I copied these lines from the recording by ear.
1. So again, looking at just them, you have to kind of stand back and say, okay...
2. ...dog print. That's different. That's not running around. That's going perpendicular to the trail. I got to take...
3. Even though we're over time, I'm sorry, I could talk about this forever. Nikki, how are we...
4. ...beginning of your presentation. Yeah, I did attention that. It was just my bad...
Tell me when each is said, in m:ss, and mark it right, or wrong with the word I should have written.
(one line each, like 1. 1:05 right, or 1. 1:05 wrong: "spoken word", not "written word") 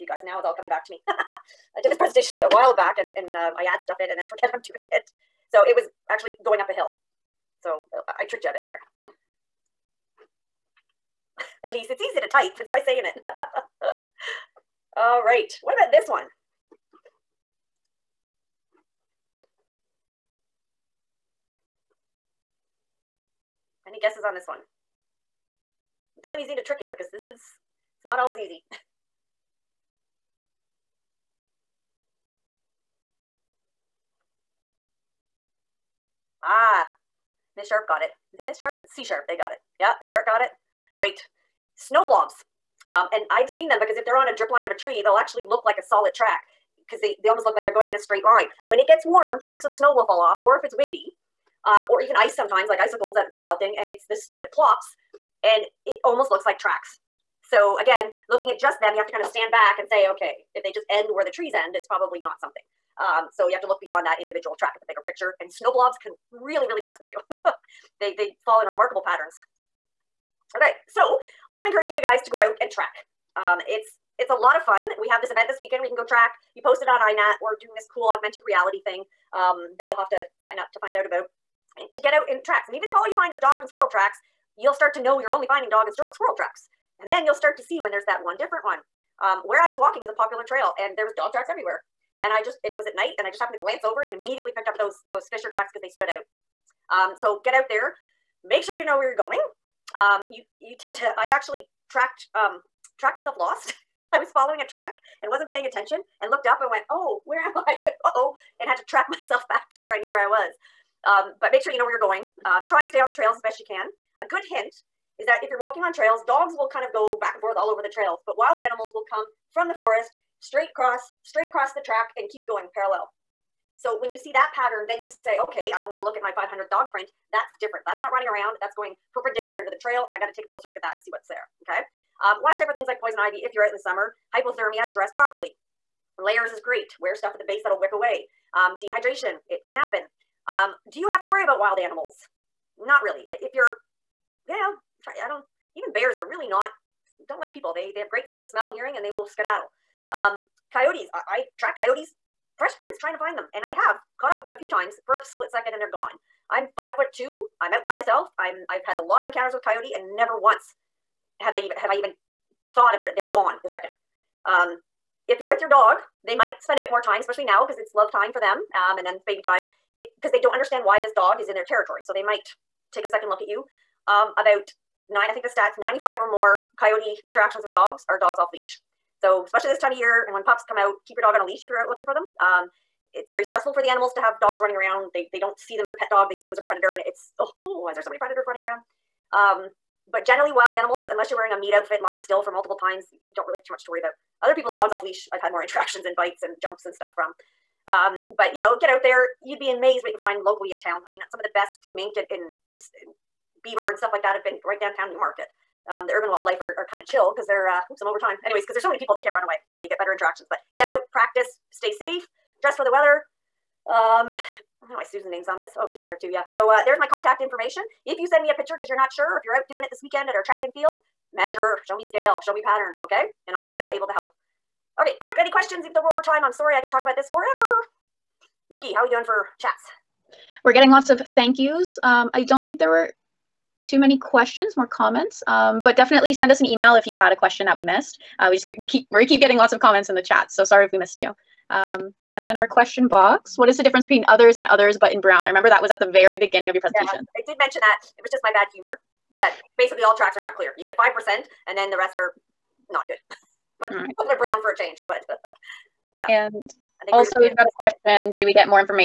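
1. 0:57 right
2. 2:06 right
3. 3:45 right
4. 4:06 wrong: "mention", not "attention".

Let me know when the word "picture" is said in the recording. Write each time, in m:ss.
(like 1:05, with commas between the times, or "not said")
1:05, 3:38.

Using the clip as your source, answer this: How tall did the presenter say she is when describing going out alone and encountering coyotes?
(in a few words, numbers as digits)
5 foot 2.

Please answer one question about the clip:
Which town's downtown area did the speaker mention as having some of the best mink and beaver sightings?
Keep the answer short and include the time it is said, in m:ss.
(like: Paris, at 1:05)
Newmarket, at 3:25.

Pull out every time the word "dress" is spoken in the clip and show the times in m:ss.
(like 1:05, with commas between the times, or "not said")
2:14, 3:32.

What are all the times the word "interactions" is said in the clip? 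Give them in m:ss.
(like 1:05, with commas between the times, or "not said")
2:57, 3:15, 3:30.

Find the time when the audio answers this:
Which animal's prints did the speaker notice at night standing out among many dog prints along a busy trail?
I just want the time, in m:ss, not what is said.
1:35.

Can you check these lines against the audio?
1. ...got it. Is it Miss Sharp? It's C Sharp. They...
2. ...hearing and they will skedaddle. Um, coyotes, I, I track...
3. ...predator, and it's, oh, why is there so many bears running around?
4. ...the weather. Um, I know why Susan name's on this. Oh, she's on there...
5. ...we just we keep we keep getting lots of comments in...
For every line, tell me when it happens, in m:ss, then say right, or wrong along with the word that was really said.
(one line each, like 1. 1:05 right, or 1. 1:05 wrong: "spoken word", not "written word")
1. 0:37 right
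2. 2:28 right
3. 3:06 wrong: "predators", not "bears"
4. 3:32 right
5. 3:58 right.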